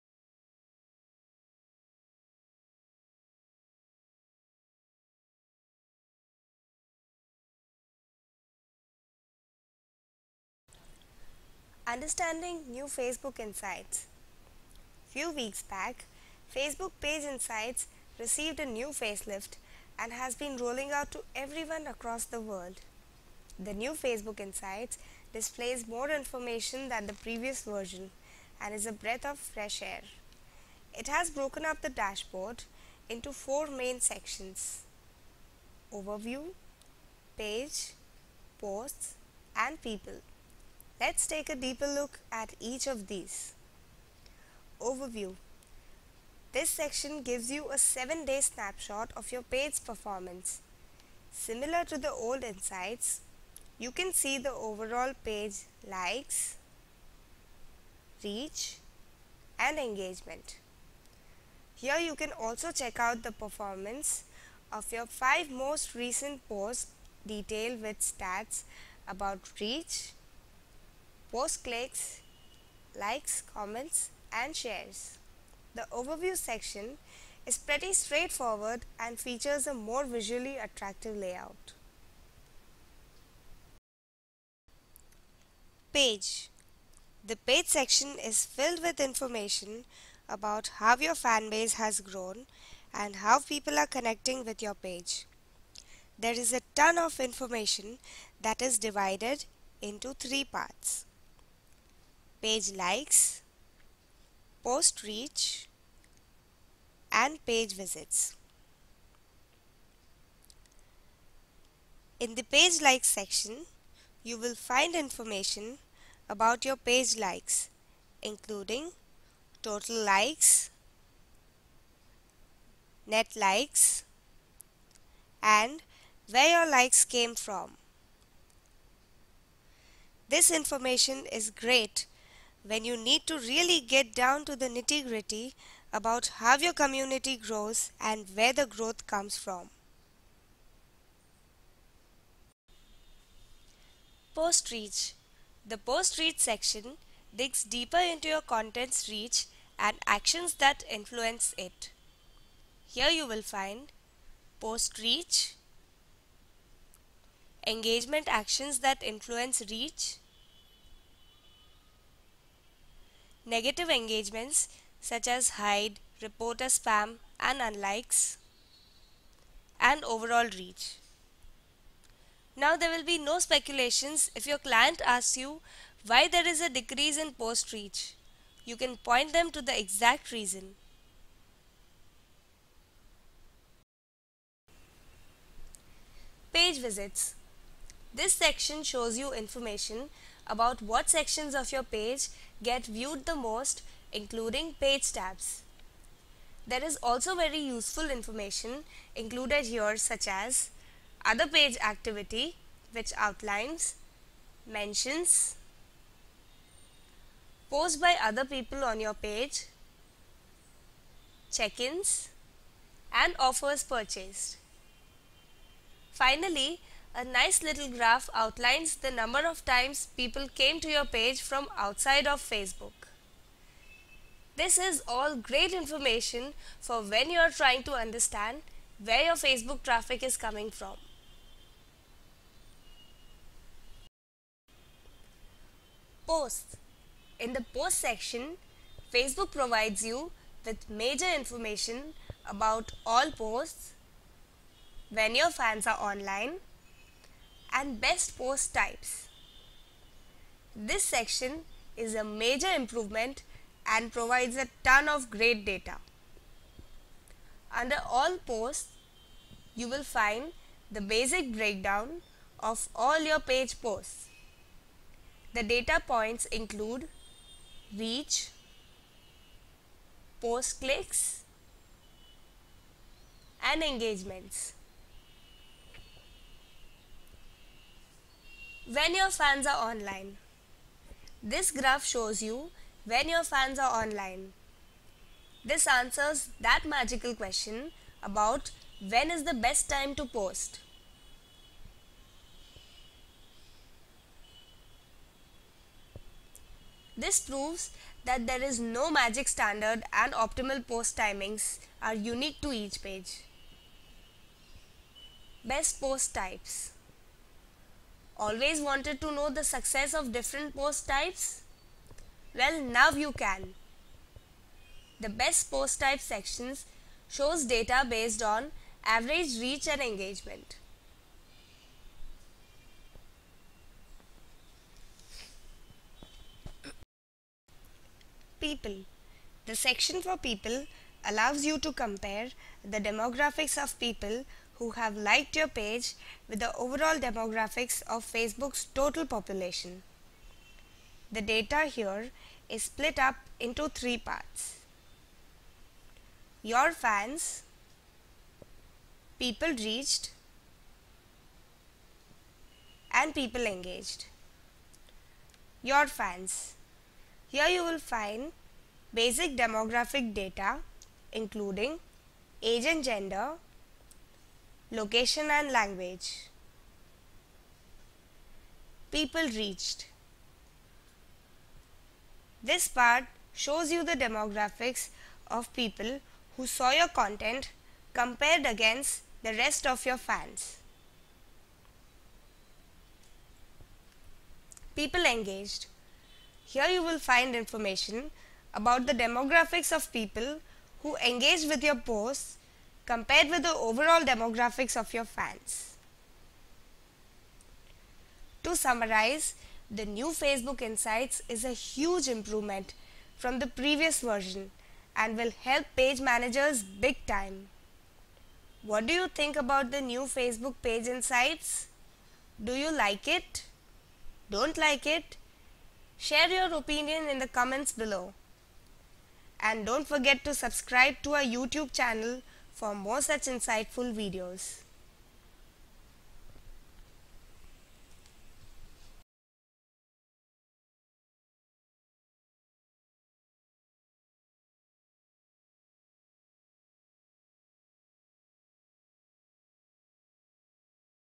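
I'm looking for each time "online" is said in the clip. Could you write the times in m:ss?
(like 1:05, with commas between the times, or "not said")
4:05, 4:39, 4:44.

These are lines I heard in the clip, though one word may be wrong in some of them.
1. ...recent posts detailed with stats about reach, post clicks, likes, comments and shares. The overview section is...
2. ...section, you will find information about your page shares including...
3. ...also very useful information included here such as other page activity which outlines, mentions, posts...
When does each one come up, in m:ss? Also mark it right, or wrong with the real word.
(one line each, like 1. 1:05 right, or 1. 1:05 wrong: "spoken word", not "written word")
1. 1:05 right
2. 1:53 wrong: "likes", not "shares"
3. 3:17 right.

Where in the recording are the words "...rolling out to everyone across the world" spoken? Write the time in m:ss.
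0:20.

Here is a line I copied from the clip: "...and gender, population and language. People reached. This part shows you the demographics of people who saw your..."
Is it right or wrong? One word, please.
wrong.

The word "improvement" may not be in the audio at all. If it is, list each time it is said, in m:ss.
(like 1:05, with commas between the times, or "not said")
4:12, 6:42.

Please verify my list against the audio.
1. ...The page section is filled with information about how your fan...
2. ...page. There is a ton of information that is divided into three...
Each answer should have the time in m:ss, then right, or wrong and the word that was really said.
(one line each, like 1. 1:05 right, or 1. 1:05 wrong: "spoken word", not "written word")
1. 1:27 right
2. 1:34 right.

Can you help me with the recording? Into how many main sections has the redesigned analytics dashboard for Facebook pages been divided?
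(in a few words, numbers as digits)
4.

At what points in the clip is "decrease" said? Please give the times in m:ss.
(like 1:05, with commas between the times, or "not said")
2:56.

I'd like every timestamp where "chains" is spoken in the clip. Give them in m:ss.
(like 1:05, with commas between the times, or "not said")
not said.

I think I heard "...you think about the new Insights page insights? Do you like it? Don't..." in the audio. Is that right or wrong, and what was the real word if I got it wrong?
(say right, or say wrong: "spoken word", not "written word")
wrong: "Facebook", not "Insights".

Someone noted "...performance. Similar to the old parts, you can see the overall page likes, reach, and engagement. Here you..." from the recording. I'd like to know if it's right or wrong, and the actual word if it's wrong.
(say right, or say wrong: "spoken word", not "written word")
wrong: "insights", not "parts".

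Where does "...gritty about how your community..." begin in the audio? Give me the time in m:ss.
2:15.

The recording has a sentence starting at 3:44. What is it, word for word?
This is all great information for when you are trying to understand where your Facebook traffic is coming from.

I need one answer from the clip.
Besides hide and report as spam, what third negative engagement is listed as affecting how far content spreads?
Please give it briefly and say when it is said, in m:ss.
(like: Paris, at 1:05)
unlikes, at 2:47.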